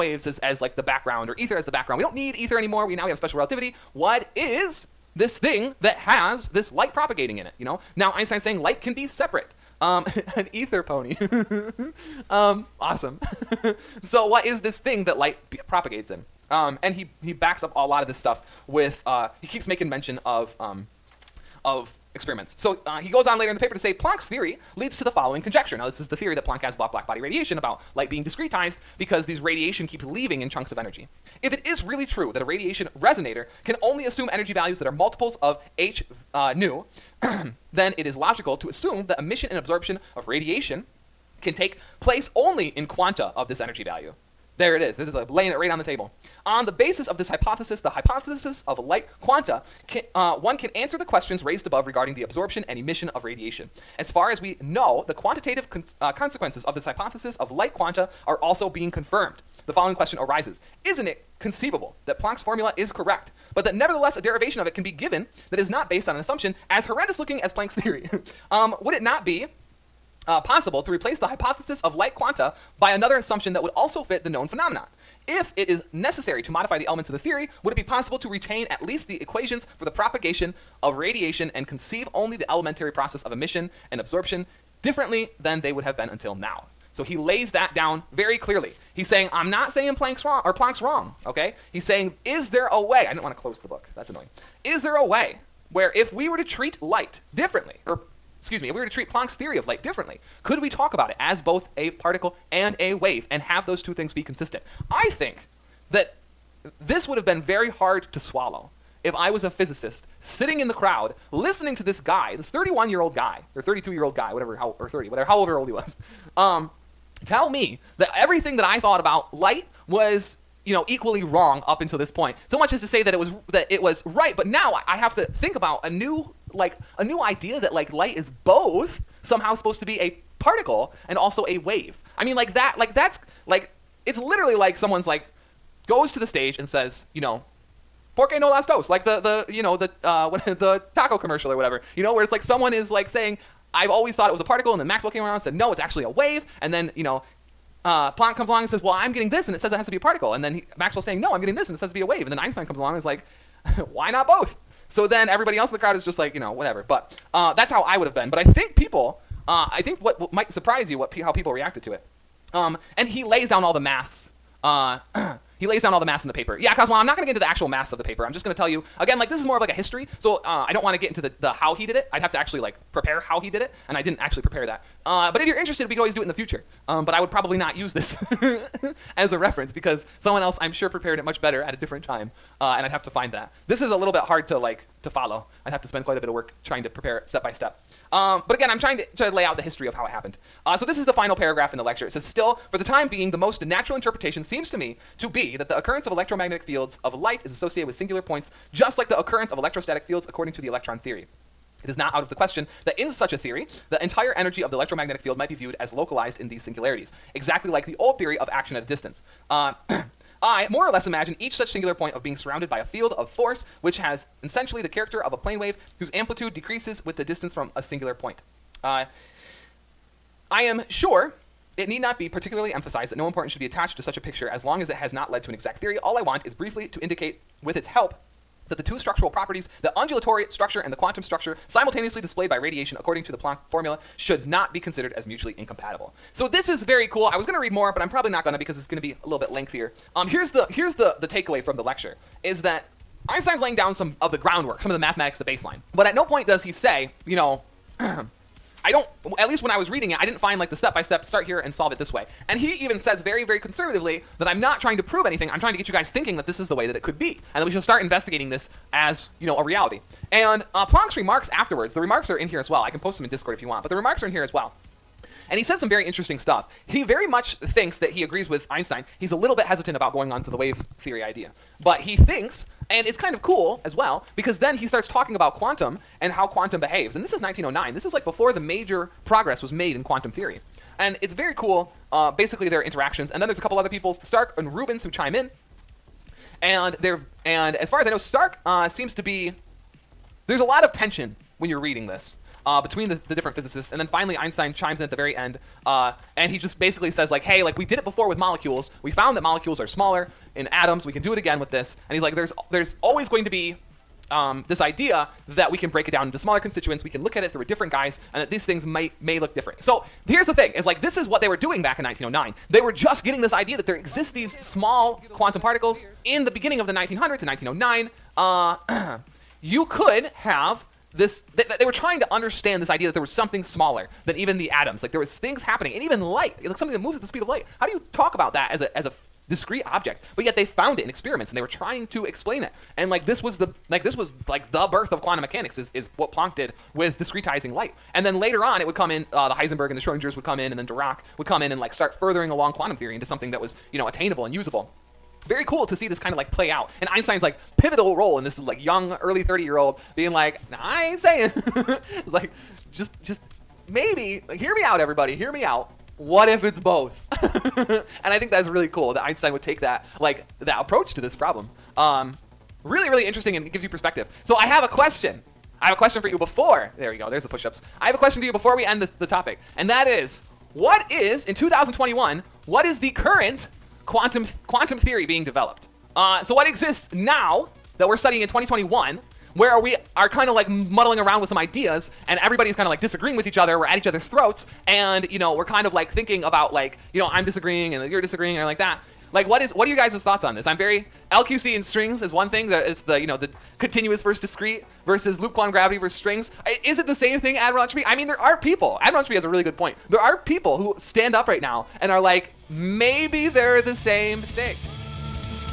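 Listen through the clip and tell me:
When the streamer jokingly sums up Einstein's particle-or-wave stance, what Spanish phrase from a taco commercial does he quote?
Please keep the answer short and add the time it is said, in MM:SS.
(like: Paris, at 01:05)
porque no las dos, at 02:18.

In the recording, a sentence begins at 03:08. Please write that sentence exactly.
Um, but again, I'm trying to, to lay out the history of how it happened.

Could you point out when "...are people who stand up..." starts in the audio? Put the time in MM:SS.
06:40.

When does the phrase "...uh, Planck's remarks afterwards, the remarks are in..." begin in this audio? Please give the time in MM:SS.
04:20.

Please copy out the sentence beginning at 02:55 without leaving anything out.
Uh, but if you're interested, we could always do it in the future.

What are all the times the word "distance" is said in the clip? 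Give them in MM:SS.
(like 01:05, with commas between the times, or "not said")
03:28, 03:37.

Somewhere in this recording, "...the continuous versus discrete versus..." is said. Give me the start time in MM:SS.
06:33.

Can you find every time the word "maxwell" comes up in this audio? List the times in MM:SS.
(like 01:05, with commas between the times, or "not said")
02:24, 02:30.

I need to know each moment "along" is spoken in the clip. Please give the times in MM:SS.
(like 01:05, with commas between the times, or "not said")
02:28, 02:32, 05:42.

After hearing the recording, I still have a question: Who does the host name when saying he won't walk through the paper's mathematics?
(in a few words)
Cosmo.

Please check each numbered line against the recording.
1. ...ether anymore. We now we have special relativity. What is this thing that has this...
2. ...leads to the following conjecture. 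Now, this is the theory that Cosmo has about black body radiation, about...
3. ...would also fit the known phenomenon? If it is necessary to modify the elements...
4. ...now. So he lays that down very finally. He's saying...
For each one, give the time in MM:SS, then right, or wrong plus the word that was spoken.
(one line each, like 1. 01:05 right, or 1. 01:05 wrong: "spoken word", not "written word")
1. 00:02 right
2. 00:24 wrong: "Planck", not "Cosmo"
3. 01:13 right
4. 01:26 wrong: "clearly", not "finally".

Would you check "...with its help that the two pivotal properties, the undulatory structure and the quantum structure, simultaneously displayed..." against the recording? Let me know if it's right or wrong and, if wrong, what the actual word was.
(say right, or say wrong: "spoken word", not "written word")
wrong: "structural", not "pivotal".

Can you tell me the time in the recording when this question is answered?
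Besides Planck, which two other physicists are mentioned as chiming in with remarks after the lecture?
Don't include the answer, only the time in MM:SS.
04:44.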